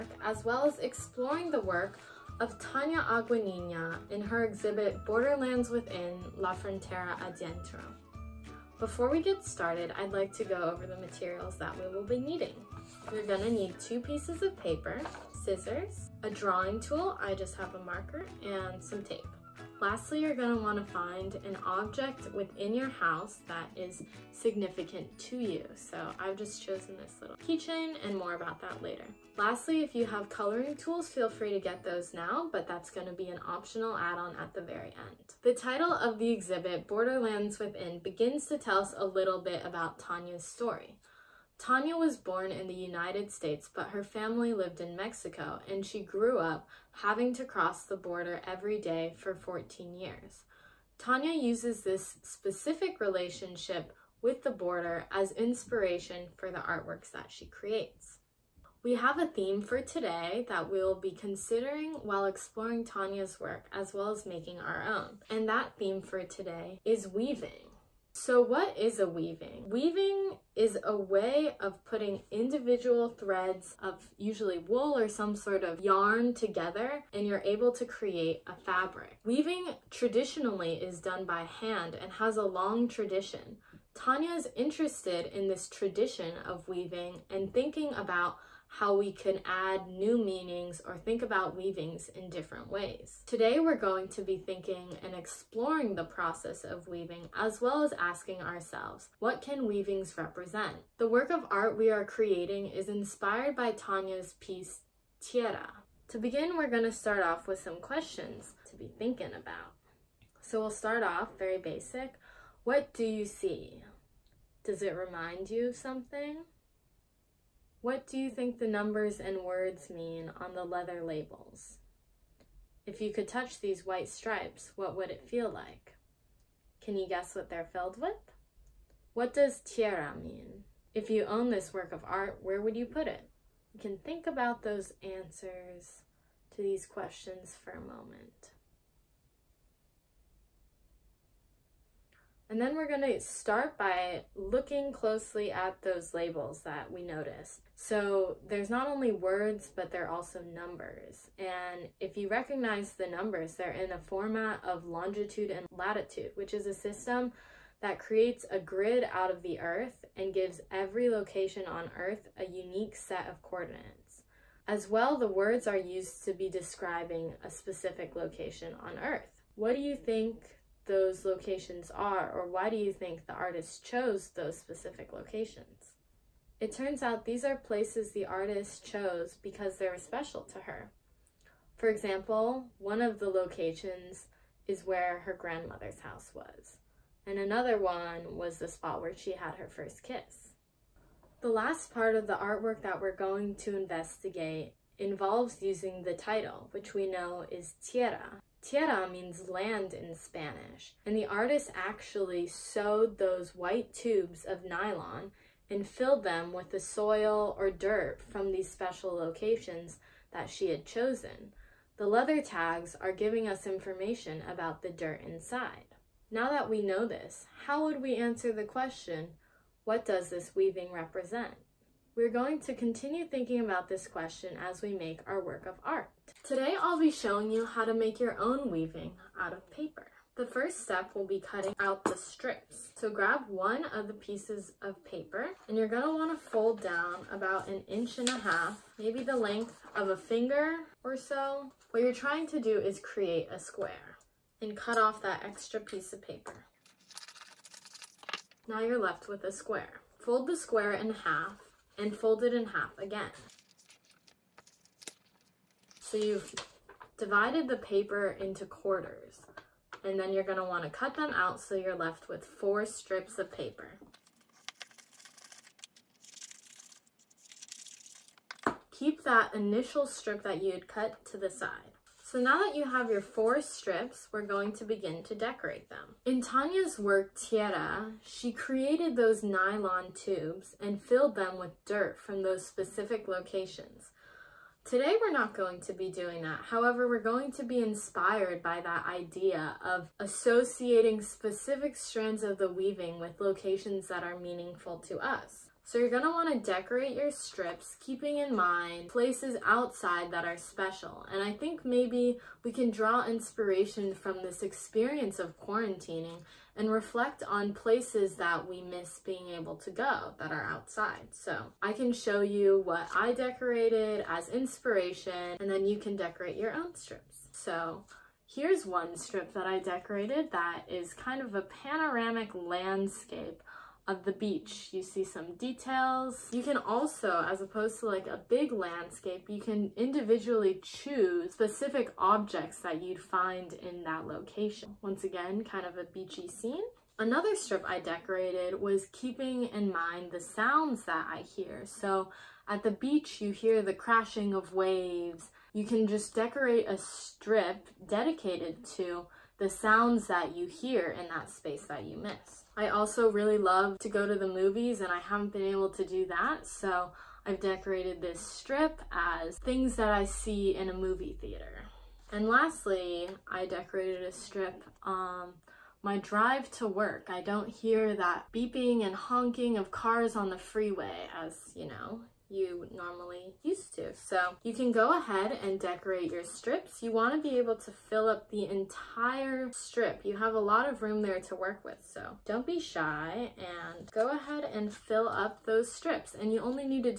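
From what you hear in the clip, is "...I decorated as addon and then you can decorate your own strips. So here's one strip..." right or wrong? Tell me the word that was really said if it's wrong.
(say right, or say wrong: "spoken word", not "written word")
wrong: "inspiration", not "addon".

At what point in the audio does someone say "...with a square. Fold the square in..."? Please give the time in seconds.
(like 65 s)
249 s.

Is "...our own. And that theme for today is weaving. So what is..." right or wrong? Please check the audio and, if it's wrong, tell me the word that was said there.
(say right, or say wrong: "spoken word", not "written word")
right.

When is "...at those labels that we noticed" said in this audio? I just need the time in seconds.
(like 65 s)
145 s.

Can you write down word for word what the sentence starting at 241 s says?
What you're trying to do is create a square and cut off that extra piece of paper.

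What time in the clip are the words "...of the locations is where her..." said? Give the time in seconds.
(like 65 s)
183 s.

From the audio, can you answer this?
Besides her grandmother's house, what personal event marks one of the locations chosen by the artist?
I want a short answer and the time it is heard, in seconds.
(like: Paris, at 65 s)
her first kiss, at 189 s.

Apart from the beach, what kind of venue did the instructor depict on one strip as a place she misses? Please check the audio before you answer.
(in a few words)
movie theater.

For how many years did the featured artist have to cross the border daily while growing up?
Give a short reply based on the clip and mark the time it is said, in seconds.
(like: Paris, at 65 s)
14, at 49 s.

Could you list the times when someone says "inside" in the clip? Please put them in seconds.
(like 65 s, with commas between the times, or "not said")
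215 s.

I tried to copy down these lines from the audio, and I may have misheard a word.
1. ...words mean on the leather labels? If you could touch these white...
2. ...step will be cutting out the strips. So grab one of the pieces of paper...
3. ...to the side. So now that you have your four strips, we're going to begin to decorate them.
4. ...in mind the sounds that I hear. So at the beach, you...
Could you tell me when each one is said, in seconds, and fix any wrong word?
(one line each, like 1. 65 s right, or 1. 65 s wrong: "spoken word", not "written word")
1. 119 s right
2. 230 s right
3. 271 s right
4. 339 s right.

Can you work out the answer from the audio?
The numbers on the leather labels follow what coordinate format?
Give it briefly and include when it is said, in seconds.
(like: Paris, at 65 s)
longitude and latitude, at 154 s.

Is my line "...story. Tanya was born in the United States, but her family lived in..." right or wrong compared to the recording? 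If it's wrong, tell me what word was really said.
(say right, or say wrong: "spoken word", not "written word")
right.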